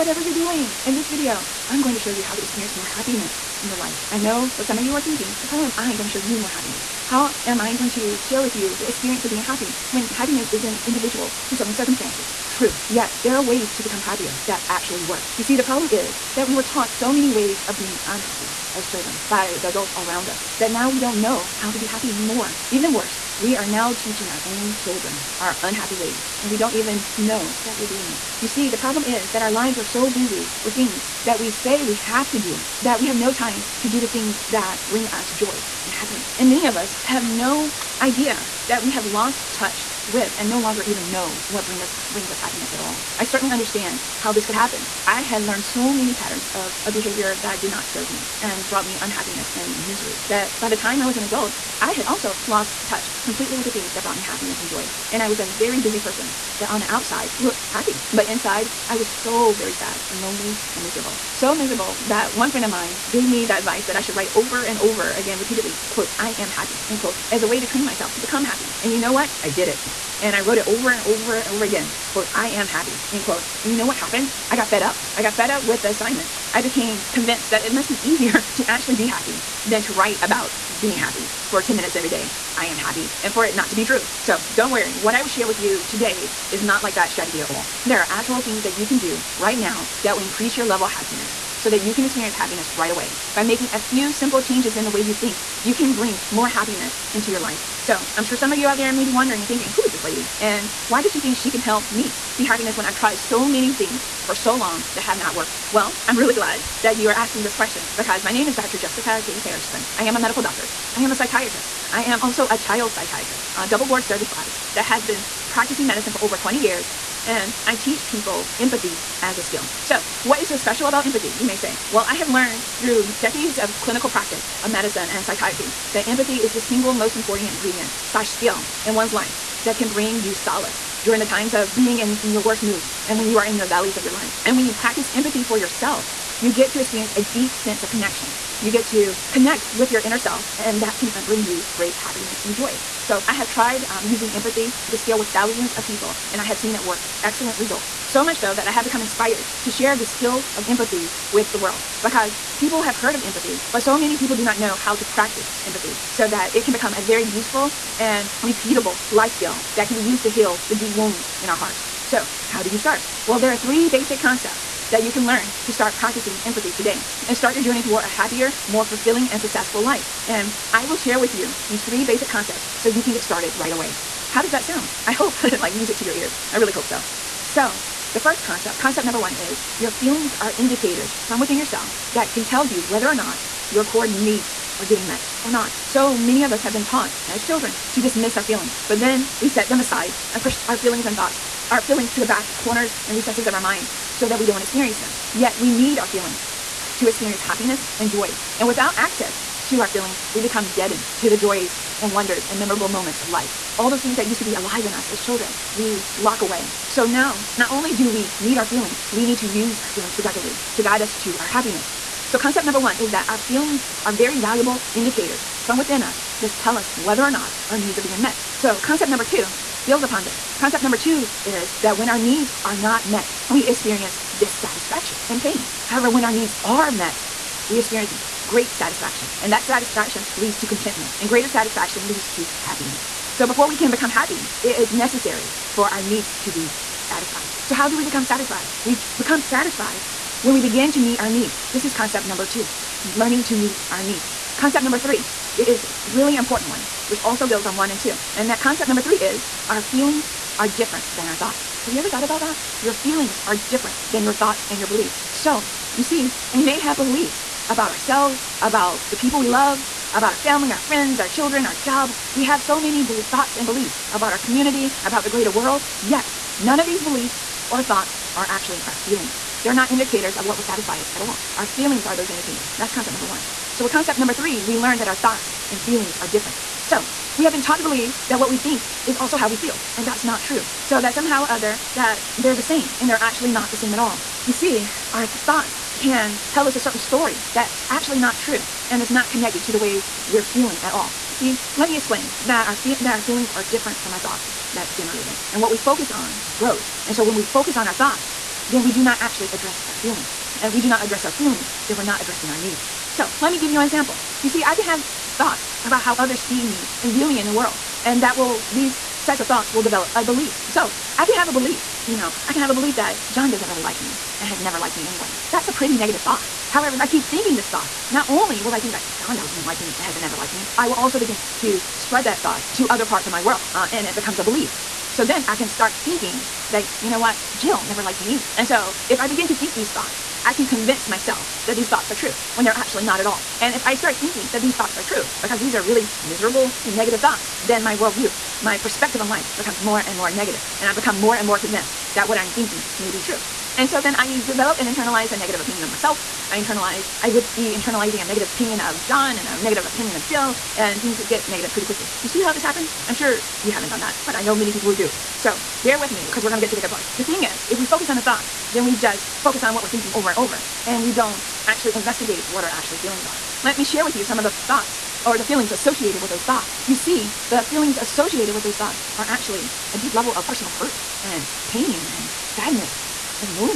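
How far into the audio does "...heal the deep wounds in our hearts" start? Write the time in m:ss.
2:40.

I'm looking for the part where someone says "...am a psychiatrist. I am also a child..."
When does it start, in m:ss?
1:50.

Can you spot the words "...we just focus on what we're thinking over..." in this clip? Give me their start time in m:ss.
5:58.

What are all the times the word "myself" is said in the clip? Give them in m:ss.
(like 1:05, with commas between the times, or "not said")
1:07, 5:31, 5:45.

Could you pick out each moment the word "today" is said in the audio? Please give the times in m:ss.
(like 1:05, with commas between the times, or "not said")
1:25, 2:46.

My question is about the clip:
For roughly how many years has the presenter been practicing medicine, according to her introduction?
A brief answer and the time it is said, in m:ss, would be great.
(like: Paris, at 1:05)
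Over 20, at 1:56.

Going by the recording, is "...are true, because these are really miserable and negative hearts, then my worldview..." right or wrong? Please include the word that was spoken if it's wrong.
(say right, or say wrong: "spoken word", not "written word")
wrong: "thoughts", not "hearts".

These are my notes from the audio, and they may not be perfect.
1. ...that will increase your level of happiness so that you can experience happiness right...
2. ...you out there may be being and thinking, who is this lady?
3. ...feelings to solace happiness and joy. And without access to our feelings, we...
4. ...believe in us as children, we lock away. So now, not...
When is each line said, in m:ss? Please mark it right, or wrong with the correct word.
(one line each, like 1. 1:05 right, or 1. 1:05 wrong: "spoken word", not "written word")
1. 1:30 right
2. 1:38 wrong: "wondering", not "being"
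3. 3:16 wrong: "experience", not "solace"
4. 3:24 wrong: "alive", not "believe".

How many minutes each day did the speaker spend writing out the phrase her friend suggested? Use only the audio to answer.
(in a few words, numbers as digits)
10.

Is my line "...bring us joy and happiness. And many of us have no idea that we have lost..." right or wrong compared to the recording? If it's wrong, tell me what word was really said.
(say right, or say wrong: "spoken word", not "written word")
right.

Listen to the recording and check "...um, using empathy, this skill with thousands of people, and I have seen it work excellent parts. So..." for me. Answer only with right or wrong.
wrong.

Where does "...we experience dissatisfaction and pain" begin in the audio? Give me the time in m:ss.
3:43.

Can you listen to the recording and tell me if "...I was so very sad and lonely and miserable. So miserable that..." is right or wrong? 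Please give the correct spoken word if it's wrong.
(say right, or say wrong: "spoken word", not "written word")
right.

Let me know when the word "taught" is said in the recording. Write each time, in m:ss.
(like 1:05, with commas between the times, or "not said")
0:16, 3:06, 4:37.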